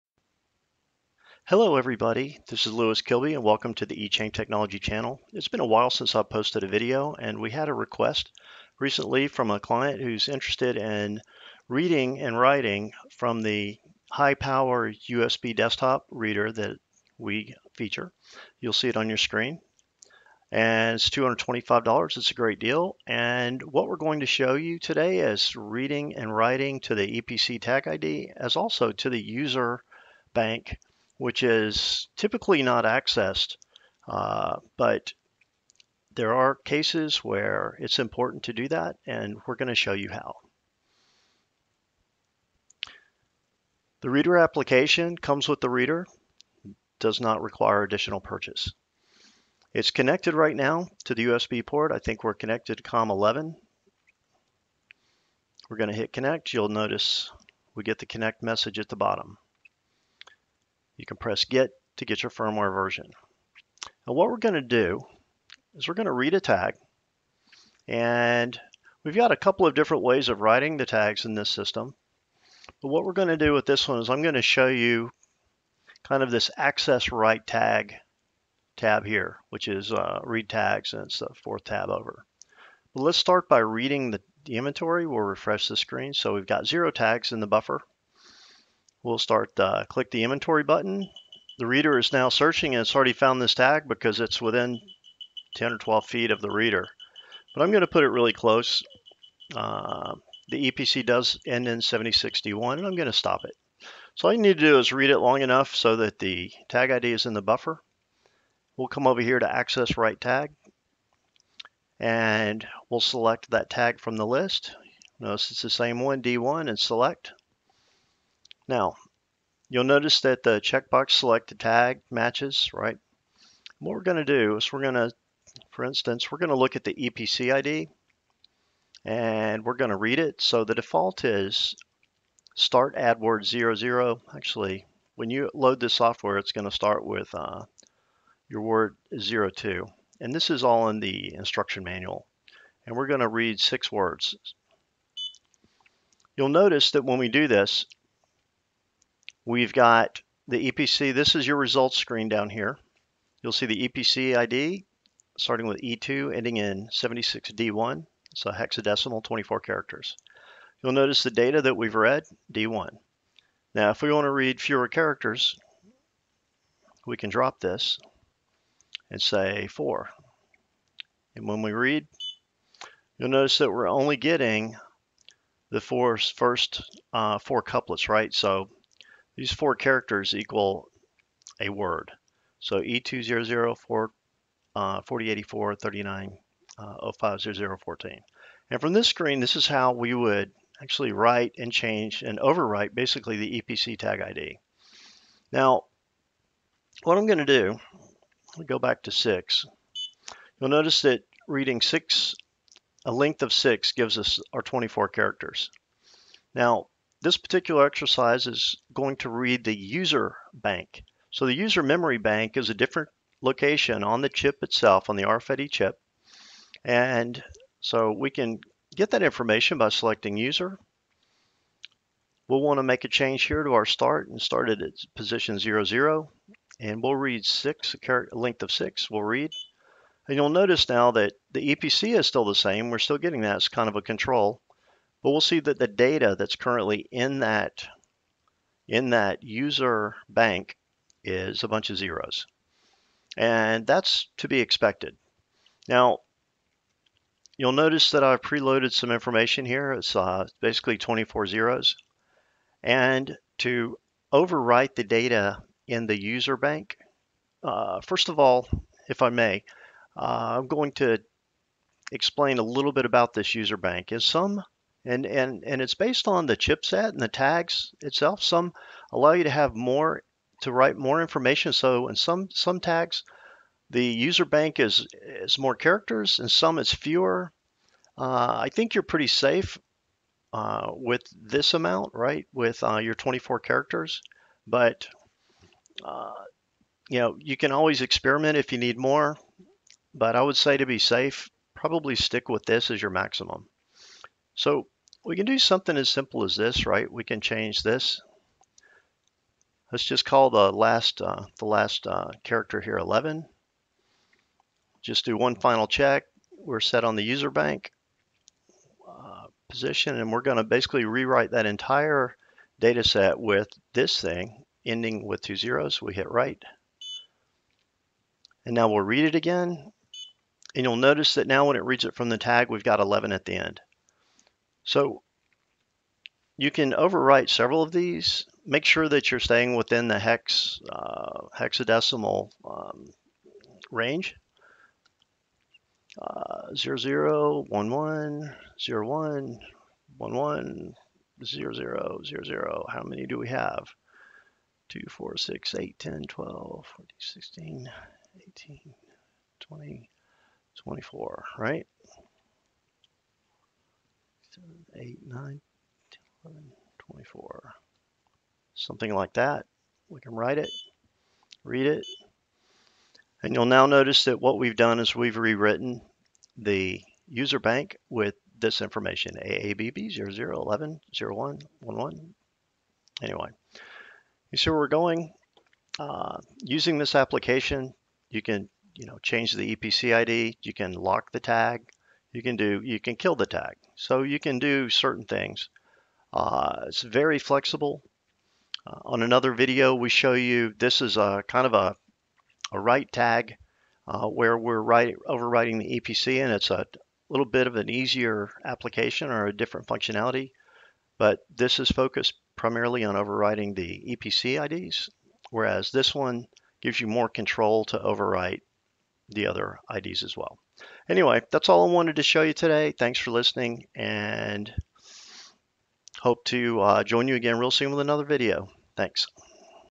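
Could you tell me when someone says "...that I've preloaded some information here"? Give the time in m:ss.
4:08.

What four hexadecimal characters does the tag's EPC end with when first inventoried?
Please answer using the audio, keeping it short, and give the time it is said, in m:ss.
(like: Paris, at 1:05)
7061, at 1:41.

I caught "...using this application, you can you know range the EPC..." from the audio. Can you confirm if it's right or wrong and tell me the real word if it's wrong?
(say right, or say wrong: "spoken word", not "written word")
wrong: "change", not "range".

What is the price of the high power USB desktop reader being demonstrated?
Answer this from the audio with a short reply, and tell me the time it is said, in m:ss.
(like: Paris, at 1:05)
$225, at 0:21.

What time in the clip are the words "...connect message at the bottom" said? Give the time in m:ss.
0:58.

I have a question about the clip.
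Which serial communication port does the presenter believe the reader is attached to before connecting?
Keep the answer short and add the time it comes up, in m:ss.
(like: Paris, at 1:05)
COM11, at 0:52.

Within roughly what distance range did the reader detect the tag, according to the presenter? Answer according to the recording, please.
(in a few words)
10 or 12 feet.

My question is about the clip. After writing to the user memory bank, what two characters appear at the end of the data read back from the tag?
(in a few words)
11.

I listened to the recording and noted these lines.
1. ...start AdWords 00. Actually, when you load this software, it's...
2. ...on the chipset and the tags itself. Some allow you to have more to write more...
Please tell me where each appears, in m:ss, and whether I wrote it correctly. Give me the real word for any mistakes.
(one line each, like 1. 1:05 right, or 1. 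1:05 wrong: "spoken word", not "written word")
1. 2:12 right
2. 4:26 right.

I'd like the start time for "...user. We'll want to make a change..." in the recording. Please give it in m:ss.
3:40.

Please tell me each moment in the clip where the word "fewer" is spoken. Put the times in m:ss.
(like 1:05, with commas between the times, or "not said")
2:44, 4:36.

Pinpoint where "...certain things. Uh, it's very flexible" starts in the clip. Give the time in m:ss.
6:24.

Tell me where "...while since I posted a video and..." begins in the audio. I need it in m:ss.
0:05.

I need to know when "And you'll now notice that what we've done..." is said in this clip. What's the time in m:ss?
6:03.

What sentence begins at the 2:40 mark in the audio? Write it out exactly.
You'll notice the data that we've read, D1.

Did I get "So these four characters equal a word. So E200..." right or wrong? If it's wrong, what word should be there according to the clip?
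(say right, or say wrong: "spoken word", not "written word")
right.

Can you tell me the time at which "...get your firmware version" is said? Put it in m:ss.
1:02.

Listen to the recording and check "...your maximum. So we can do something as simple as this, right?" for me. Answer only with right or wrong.
right.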